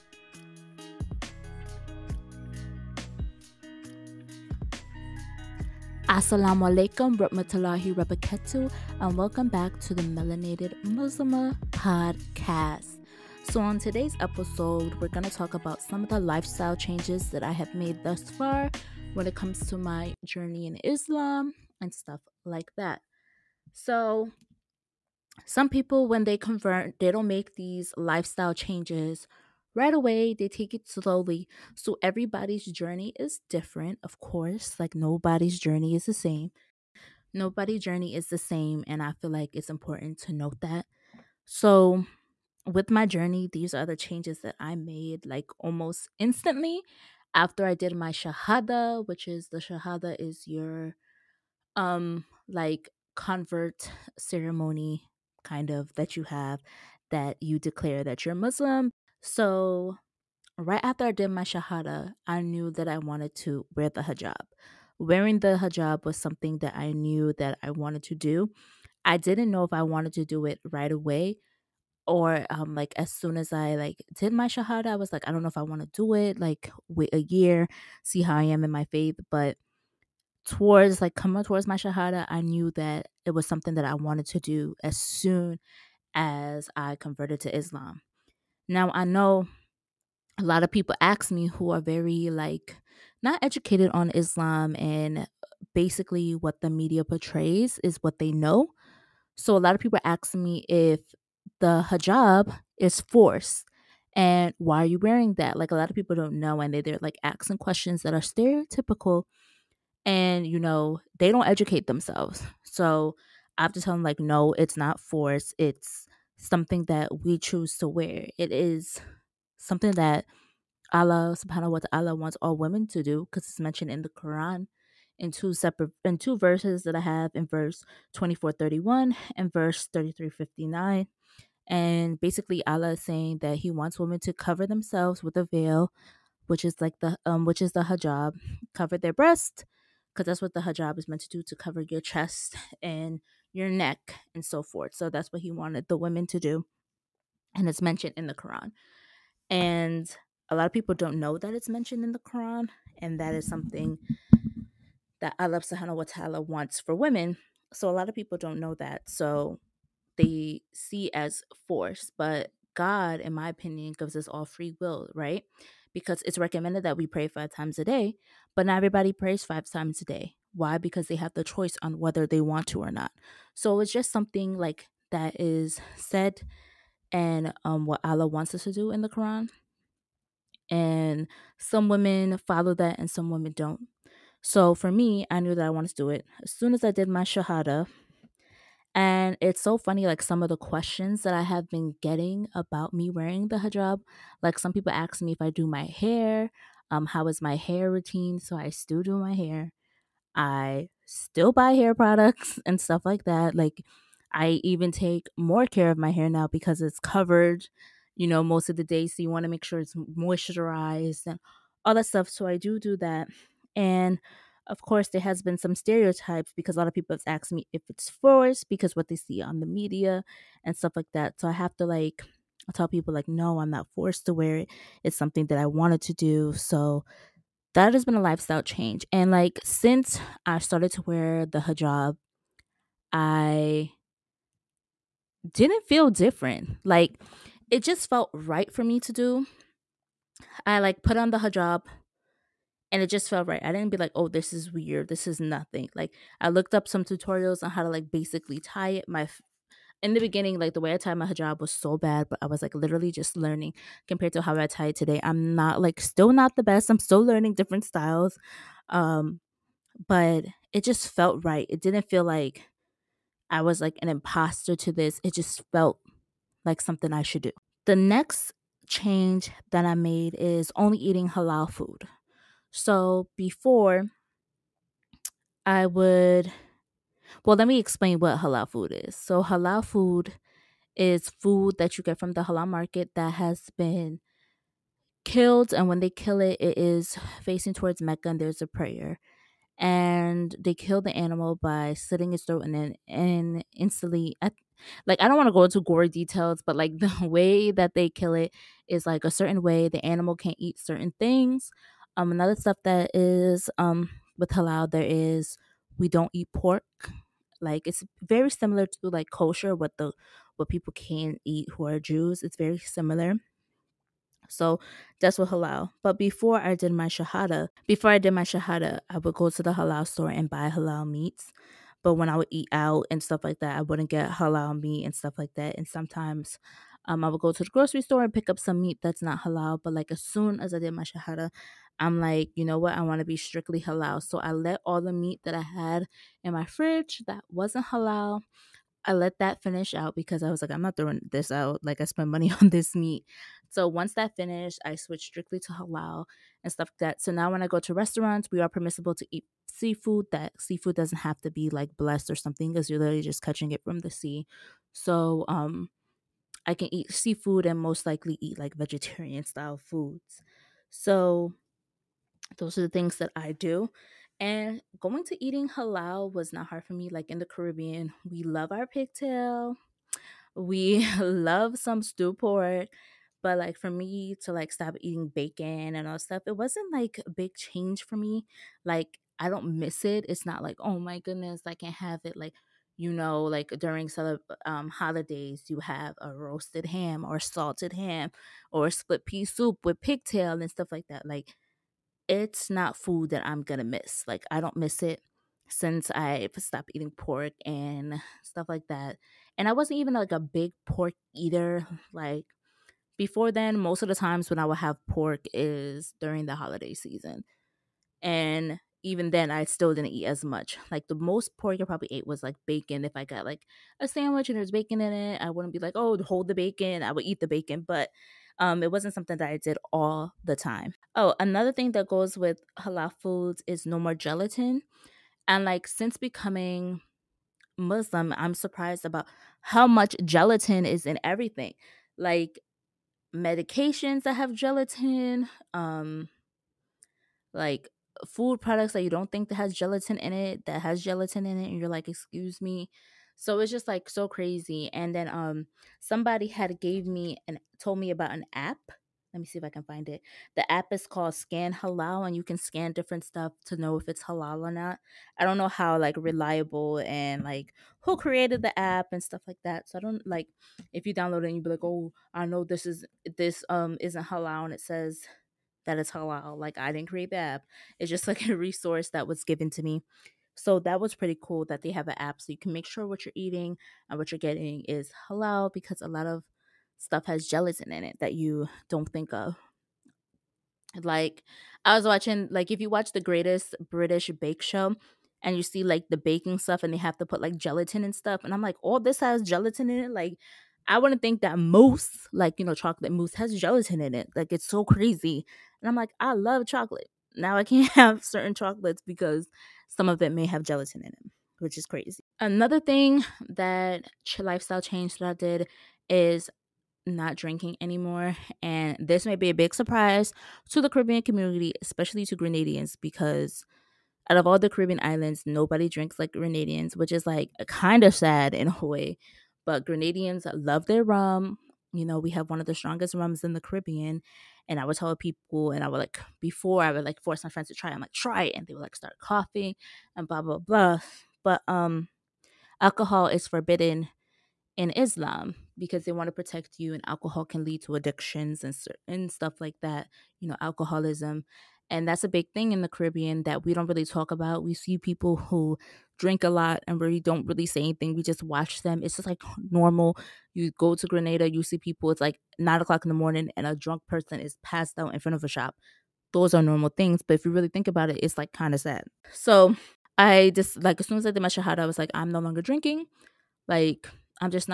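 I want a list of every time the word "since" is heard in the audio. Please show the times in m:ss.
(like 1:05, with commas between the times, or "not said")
3:49, 6:35, 7:05.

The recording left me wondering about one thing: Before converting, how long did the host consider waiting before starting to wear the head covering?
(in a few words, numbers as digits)
a year.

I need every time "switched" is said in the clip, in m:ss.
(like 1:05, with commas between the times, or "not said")
5:44.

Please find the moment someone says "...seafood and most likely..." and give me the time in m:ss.
5:57.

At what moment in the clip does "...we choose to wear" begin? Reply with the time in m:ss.
1:57.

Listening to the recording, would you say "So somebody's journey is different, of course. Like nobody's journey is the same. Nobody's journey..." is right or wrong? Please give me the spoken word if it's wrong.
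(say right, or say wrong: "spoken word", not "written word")
wrong: "everybody", not "somebody".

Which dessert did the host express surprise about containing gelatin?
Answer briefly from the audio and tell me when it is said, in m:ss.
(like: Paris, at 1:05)
chocolate mousse, at 8:12.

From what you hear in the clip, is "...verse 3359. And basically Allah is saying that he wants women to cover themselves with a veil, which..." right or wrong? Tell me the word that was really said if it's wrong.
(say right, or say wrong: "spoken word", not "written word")
right.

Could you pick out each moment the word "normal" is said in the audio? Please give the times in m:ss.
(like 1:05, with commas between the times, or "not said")
9:09, 9:16.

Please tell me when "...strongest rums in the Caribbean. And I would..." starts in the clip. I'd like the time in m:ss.
8:42.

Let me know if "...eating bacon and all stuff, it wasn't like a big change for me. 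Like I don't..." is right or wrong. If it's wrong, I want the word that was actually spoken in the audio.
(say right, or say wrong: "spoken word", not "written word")
right.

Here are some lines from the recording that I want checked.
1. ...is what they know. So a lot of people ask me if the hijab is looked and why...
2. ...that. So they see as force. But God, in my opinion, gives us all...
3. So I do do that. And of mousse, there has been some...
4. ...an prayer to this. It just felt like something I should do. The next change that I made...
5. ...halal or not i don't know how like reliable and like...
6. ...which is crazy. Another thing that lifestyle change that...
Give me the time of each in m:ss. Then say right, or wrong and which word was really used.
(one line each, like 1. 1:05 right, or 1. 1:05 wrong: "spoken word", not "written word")
1. 1:37 wrong: "forced", not "looked"
2. 2:38 right
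3. 3:32 wrong: "course", not "mousse"
4. 4:24 wrong: "imposter", not "prayer"
5. 7:34 right
6. 8:21 right.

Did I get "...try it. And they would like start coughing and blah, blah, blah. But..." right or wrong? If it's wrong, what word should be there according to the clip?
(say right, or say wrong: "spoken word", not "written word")
right.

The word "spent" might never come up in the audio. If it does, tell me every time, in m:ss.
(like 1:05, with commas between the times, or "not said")
5:42.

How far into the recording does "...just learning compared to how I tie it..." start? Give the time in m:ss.
4:13.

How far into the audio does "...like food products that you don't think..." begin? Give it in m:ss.
7:17.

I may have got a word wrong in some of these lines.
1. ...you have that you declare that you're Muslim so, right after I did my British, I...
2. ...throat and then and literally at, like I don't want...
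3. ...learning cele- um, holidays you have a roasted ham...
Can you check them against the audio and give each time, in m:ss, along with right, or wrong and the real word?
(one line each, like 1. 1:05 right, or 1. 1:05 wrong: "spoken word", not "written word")
1. 0:56 wrong: "Shahada", not "British"
2. 4:52 wrong: "instantly", not "literally"
3. 6:23 wrong: "during", not "learning".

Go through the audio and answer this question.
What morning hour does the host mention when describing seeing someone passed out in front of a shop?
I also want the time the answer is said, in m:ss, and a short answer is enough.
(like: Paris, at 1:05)
9 o'clock, at 9:12.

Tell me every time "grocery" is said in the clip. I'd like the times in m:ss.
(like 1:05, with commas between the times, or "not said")
5:27.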